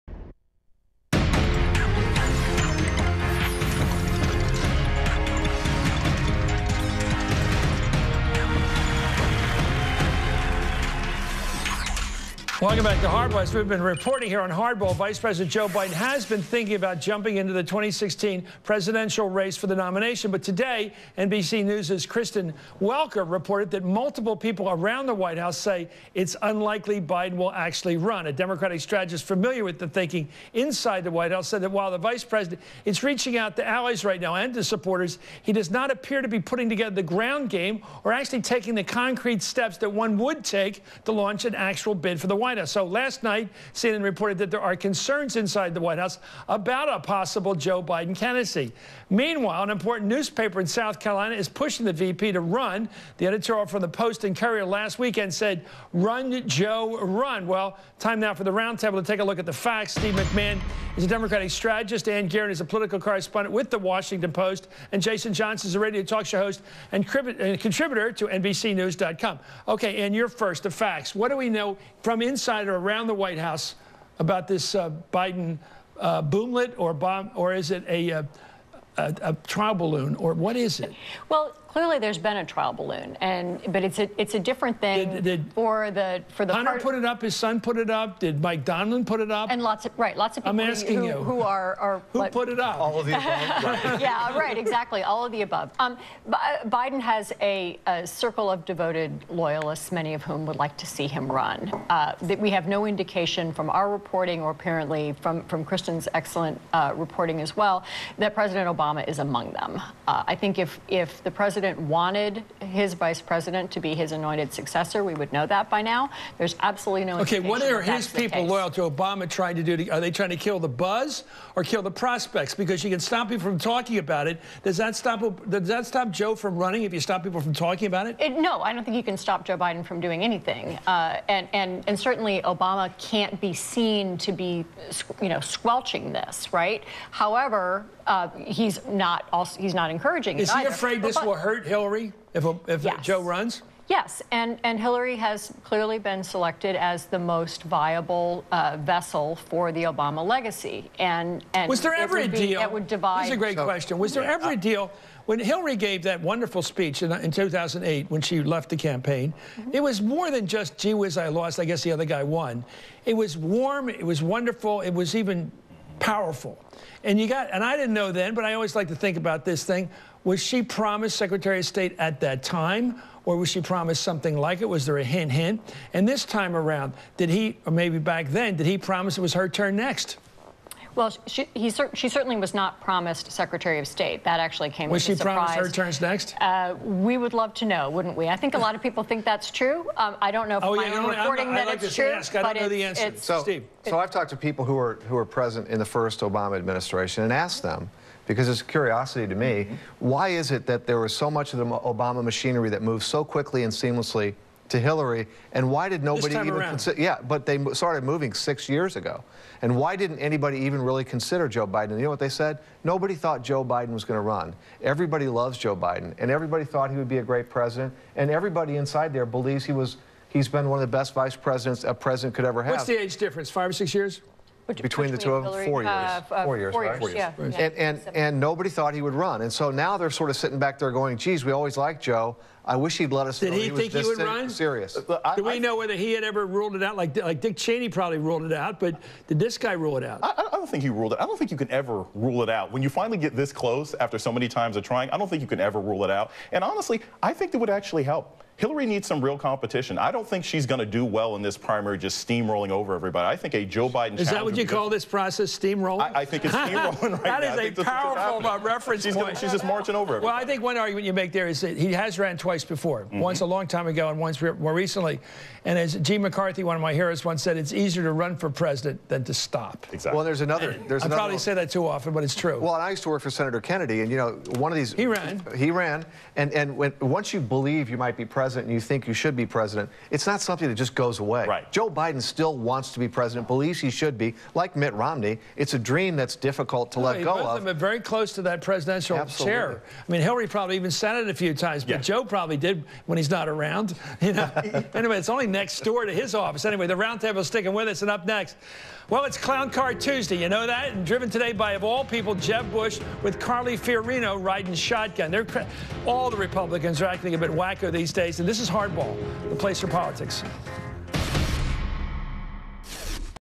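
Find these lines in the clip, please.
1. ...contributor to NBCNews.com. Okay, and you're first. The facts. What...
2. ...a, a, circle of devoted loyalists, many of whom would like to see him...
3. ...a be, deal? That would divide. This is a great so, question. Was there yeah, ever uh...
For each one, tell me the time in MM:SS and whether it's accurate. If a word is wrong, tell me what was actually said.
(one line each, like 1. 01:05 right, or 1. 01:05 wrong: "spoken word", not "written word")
1. 01:07 right
2. 01:37 right
3. 02:32 right.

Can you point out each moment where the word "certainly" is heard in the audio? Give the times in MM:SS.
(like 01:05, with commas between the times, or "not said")
02:11, 03:02.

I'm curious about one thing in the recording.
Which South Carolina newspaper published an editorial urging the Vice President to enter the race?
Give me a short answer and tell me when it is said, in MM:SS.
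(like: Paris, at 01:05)
Post and Courier, at 00:53.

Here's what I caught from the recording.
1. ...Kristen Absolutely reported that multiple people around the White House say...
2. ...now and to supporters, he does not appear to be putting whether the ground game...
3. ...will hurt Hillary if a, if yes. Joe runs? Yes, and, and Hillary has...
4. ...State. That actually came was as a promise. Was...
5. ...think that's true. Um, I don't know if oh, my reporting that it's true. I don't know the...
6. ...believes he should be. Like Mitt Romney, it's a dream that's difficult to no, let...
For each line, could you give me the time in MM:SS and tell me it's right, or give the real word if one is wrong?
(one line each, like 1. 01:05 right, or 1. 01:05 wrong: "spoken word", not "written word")
1. 00:22 wrong: "Welker", not "Absolutely"
2. 00:34 wrong: "together", not "whether"
3. 02:21 right
4. 03:03 wrong: "surprise", not "promise"
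5. 03:09 right
6. 04:43 right.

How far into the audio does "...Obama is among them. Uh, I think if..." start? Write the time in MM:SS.
01:48.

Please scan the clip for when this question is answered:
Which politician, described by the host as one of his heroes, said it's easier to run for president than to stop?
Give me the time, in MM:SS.
04:26.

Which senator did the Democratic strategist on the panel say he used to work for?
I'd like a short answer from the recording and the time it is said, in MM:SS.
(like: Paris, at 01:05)
Senator Kennedy, at 04:33.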